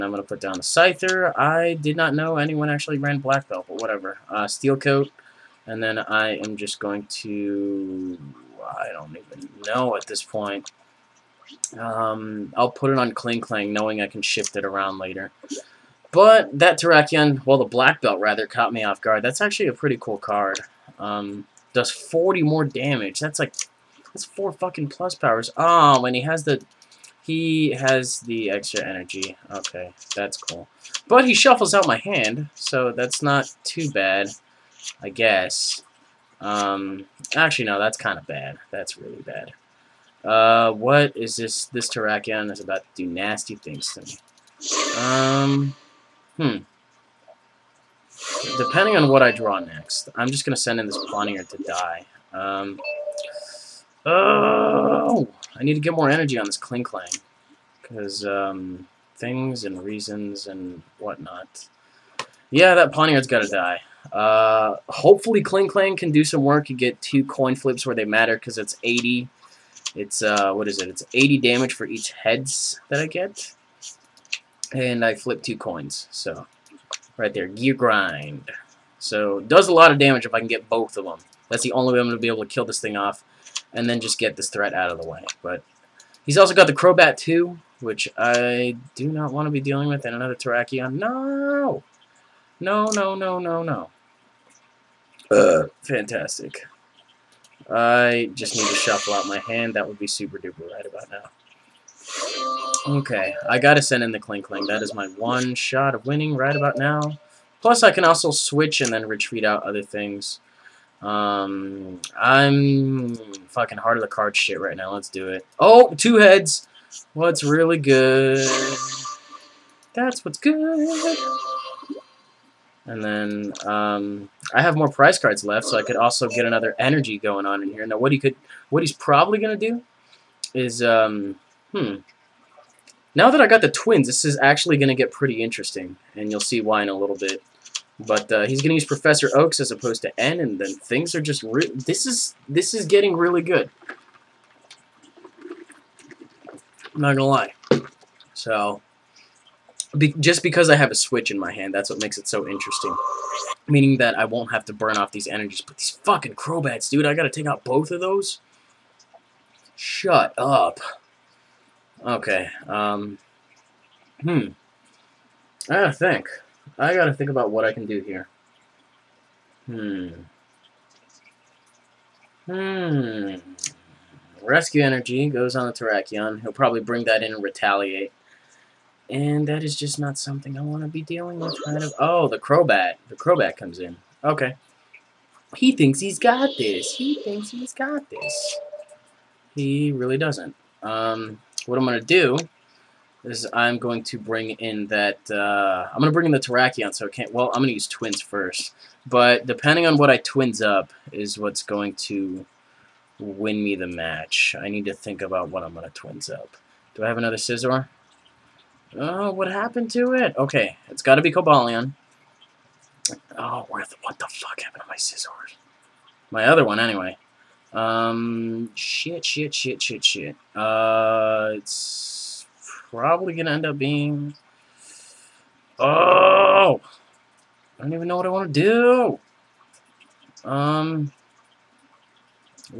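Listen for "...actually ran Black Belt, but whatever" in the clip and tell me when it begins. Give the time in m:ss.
0:02.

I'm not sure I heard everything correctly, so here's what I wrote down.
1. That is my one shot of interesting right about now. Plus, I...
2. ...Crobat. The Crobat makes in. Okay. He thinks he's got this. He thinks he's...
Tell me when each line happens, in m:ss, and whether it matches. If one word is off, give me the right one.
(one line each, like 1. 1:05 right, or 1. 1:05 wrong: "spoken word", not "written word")
1. 1:44 wrong: "winning", not "interesting"
2. 3:02 wrong: "comes", not "makes".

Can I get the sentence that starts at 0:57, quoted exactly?
Because, um, things and reasons and whatnot.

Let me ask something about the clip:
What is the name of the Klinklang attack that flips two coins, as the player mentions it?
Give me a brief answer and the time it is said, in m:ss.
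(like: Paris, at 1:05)
Gear Grind, at 1:17.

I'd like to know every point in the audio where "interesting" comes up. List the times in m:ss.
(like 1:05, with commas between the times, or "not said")
2:15, 2:32.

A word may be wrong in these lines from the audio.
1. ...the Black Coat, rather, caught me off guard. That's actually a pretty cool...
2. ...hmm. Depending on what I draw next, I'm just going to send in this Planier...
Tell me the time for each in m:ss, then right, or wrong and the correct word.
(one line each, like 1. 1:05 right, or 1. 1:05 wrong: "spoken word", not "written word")
1. 0:17 wrong: "Belt", not "Coat"
2. 0:46 right.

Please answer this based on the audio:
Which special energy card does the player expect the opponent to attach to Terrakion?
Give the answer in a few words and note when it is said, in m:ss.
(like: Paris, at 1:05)
Rescue Energy, at 2:54.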